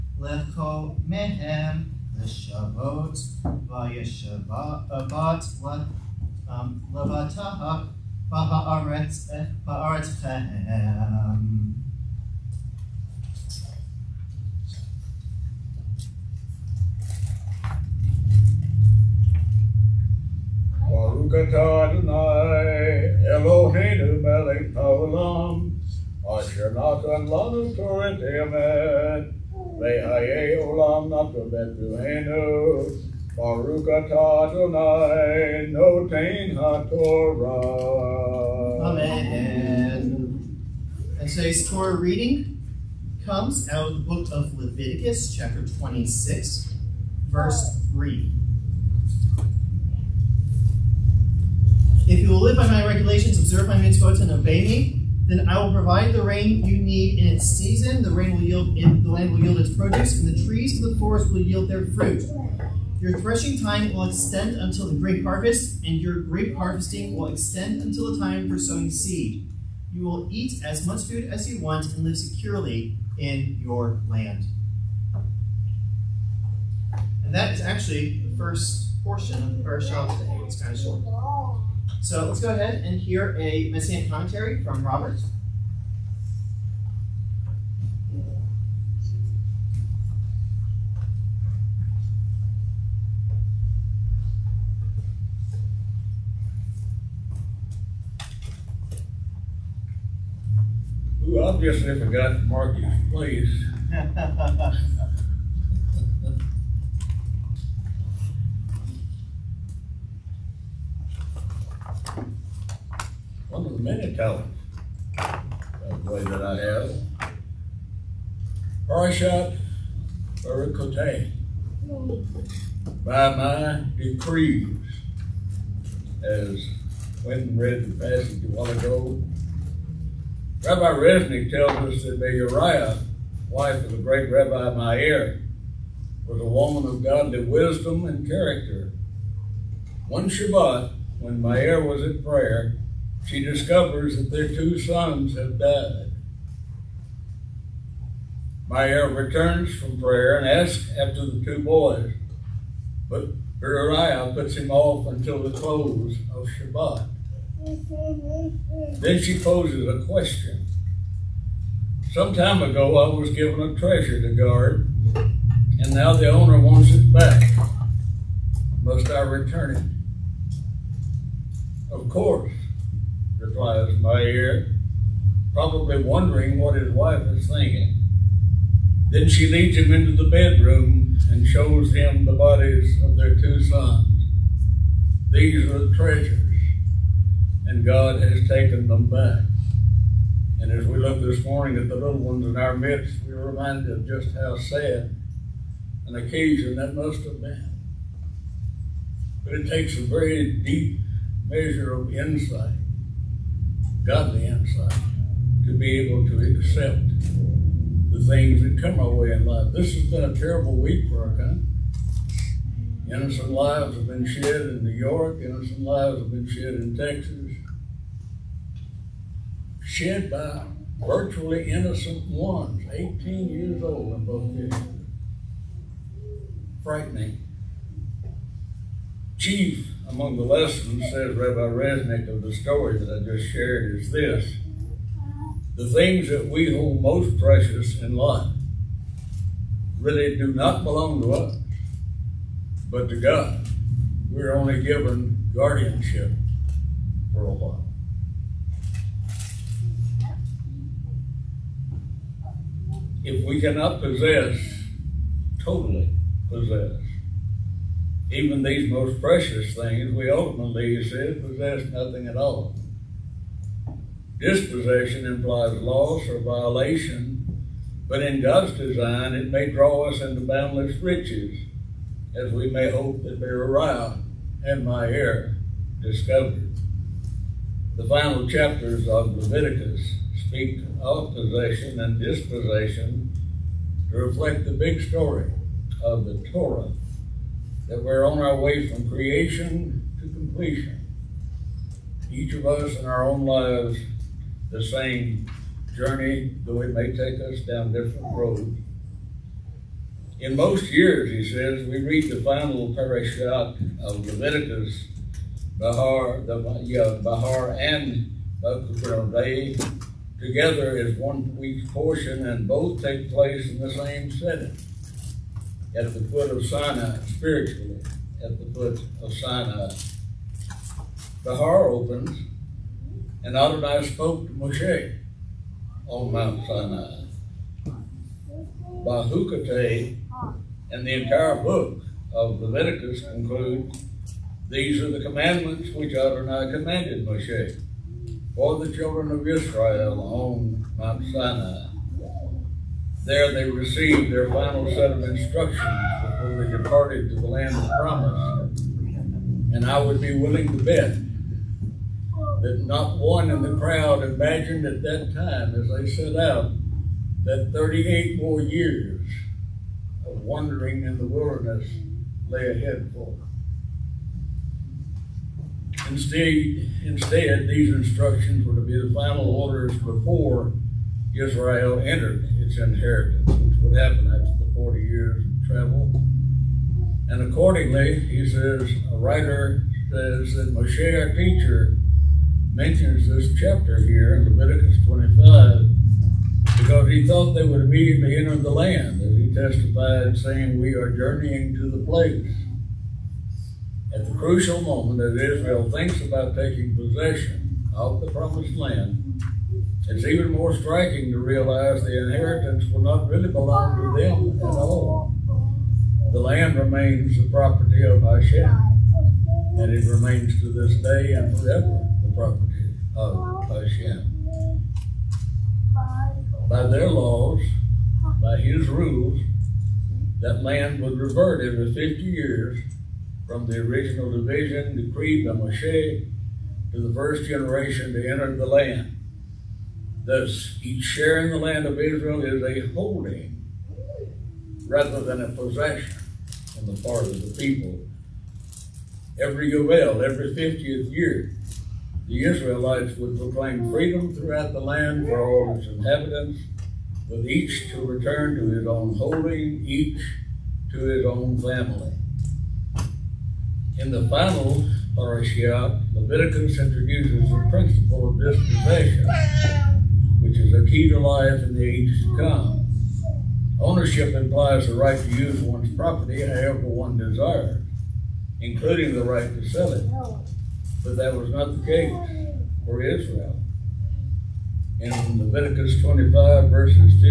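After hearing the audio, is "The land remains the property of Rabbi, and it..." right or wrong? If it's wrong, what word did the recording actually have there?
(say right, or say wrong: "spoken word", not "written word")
wrong: "Hashem", not "Rabbi".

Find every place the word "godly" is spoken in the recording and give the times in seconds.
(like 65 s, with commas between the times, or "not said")
137 s, 204 s.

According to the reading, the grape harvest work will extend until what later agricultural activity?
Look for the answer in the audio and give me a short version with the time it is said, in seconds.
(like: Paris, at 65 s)
sowing seed, at 68 s.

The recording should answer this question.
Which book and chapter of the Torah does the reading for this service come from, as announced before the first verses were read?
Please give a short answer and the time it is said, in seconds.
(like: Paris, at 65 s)
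Leviticus 26, at 44 s.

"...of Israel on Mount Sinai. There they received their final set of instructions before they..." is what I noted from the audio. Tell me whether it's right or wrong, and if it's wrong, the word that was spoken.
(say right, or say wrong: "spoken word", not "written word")
right.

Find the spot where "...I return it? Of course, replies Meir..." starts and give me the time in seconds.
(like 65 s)
169 s.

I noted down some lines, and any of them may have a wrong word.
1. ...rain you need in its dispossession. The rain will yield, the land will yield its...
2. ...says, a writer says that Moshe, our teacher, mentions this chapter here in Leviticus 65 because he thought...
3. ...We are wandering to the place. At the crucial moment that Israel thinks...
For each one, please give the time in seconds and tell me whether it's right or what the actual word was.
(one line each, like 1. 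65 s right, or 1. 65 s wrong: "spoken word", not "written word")
1. 56 s wrong: "season", not "dispossession"
2. 378 s wrong: "25", not "65"
3. 390 s wrong: "journeying", not "wandering".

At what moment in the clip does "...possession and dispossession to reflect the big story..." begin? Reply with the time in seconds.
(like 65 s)
281 s.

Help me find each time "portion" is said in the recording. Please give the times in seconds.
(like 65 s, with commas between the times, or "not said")
79 s, 311 s.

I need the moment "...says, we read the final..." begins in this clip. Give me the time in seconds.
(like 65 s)
301 s.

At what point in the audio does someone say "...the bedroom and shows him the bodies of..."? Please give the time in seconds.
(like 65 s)
180 s.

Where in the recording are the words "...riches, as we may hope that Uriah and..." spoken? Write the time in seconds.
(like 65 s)
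270 s.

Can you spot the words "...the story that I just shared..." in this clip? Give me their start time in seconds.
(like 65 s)
232 s.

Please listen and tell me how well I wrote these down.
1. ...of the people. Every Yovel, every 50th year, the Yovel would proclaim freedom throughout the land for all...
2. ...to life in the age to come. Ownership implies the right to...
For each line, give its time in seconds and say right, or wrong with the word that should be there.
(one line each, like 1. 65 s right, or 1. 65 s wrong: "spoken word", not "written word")
1. 437 s wrong: "Israelites", not "Yovel"
2. 461 s right.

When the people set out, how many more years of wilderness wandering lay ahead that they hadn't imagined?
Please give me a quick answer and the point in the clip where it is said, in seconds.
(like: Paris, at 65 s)
38, at 357 s.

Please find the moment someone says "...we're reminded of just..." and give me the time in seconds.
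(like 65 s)
193 s.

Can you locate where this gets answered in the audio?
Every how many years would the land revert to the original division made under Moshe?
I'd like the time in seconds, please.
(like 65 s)
421 s.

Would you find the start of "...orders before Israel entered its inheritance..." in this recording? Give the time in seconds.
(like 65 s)
369 s.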